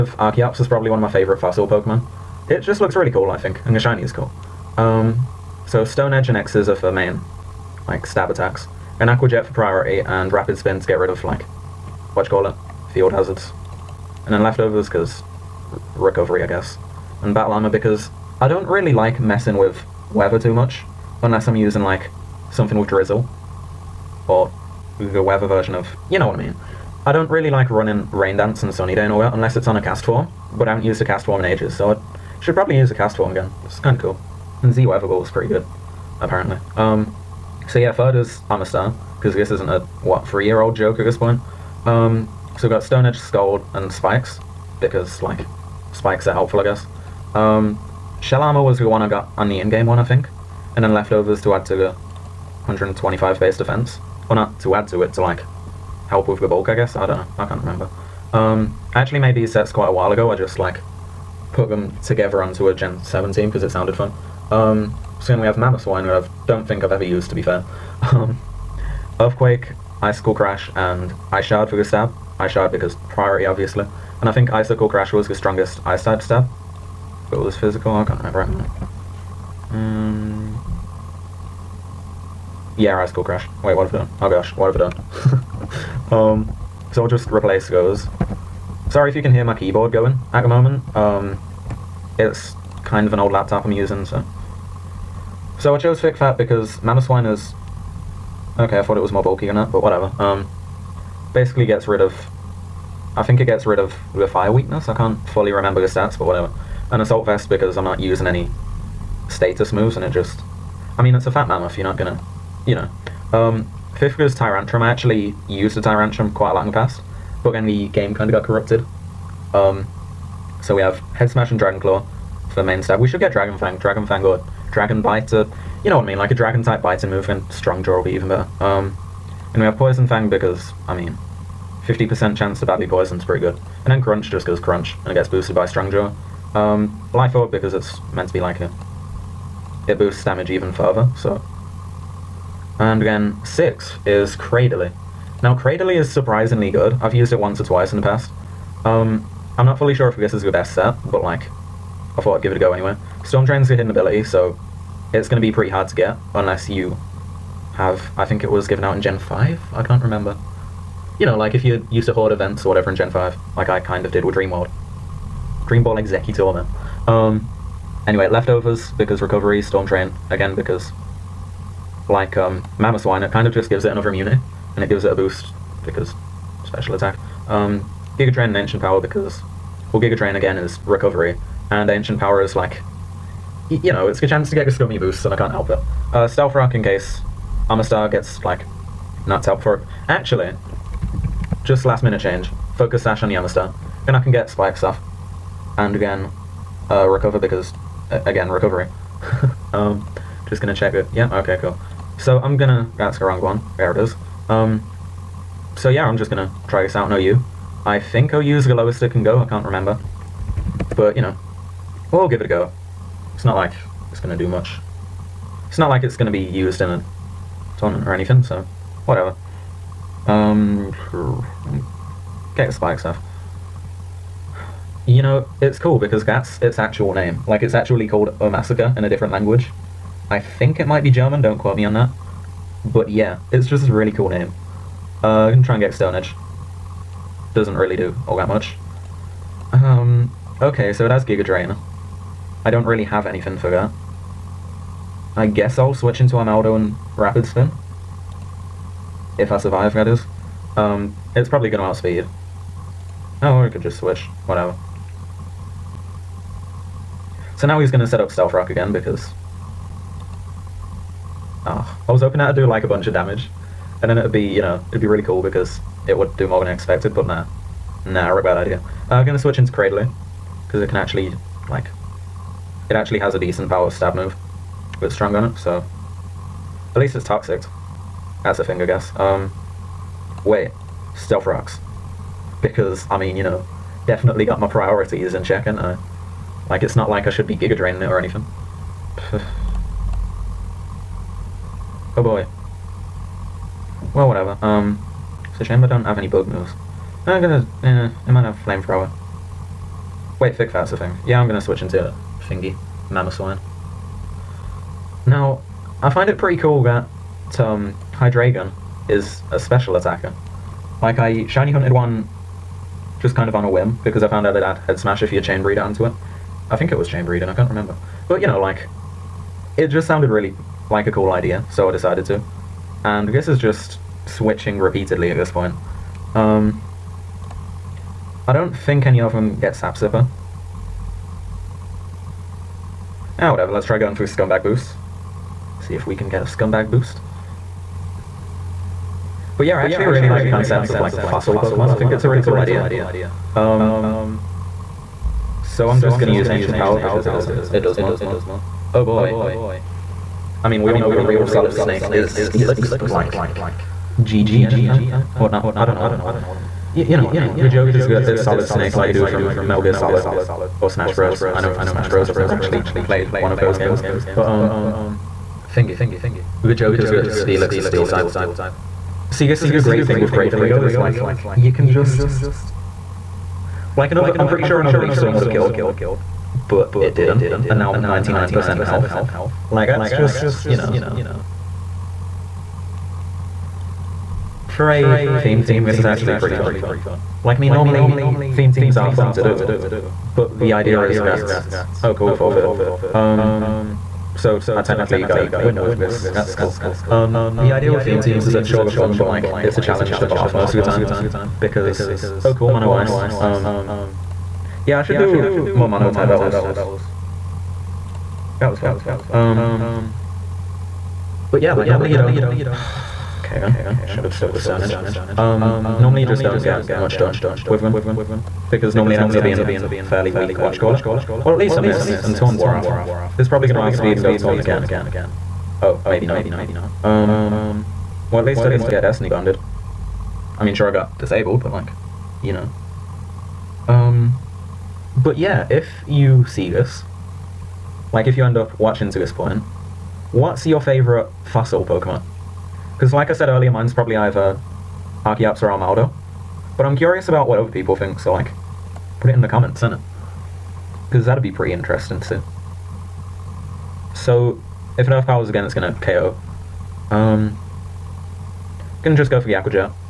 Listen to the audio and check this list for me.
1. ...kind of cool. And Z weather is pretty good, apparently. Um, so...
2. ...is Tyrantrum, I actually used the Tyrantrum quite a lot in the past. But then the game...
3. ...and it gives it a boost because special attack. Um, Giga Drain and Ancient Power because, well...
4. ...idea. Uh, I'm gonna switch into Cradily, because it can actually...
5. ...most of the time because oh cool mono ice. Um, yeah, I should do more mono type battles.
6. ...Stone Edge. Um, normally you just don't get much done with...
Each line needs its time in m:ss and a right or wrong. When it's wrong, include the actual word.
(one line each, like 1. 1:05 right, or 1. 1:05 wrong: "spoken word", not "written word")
1. 0:33 right
2. 1:54 right
3. 2:54 right
4. 4:28 right
5. 6:40 right
6. 6:54 right.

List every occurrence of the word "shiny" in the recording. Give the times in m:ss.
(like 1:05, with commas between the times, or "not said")
0:03, 5:11.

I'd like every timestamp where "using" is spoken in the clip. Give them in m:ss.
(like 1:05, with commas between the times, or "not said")
0:21, 1:33, 1:47.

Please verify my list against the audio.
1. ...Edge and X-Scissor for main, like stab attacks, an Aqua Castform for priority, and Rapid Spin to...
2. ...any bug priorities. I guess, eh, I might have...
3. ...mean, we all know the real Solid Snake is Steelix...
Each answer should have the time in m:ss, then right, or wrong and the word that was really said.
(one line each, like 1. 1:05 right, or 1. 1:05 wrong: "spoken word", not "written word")
1. 0:06 wrong: "Jet", not "Castform"
2. 4:56 wrong: "moves", not "priorities"
3. 5:50 right.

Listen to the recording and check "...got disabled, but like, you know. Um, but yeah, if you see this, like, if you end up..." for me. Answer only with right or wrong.
right.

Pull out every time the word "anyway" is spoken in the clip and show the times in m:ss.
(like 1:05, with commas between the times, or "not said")
2:32, 2:48.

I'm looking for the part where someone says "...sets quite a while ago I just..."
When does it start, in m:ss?
0:59.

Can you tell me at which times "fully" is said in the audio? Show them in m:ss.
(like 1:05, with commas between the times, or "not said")
1:45, 2:29.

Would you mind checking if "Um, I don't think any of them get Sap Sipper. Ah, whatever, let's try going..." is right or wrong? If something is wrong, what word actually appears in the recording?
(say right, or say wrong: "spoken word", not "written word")
right.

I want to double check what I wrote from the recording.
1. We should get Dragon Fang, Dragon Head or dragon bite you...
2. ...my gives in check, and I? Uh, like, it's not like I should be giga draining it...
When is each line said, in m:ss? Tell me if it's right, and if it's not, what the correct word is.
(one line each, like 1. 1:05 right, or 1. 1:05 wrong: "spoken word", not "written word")
1. 2:02 wrong: "Fang", not "Head"
2. 4:44 wrong: "priorities", not "gives".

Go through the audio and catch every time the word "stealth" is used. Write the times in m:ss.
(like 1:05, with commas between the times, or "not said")
3:06, 4:18, 4:41.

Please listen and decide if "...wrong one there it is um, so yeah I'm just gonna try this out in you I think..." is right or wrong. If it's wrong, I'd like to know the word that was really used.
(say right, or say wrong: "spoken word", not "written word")
right.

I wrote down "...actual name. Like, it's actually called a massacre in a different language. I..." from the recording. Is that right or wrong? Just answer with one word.
right.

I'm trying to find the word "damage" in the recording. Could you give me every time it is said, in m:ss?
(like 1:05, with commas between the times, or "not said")
2:20, 4:23.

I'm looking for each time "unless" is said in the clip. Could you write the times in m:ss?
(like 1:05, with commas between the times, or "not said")
0:21, 0:29, 2:36.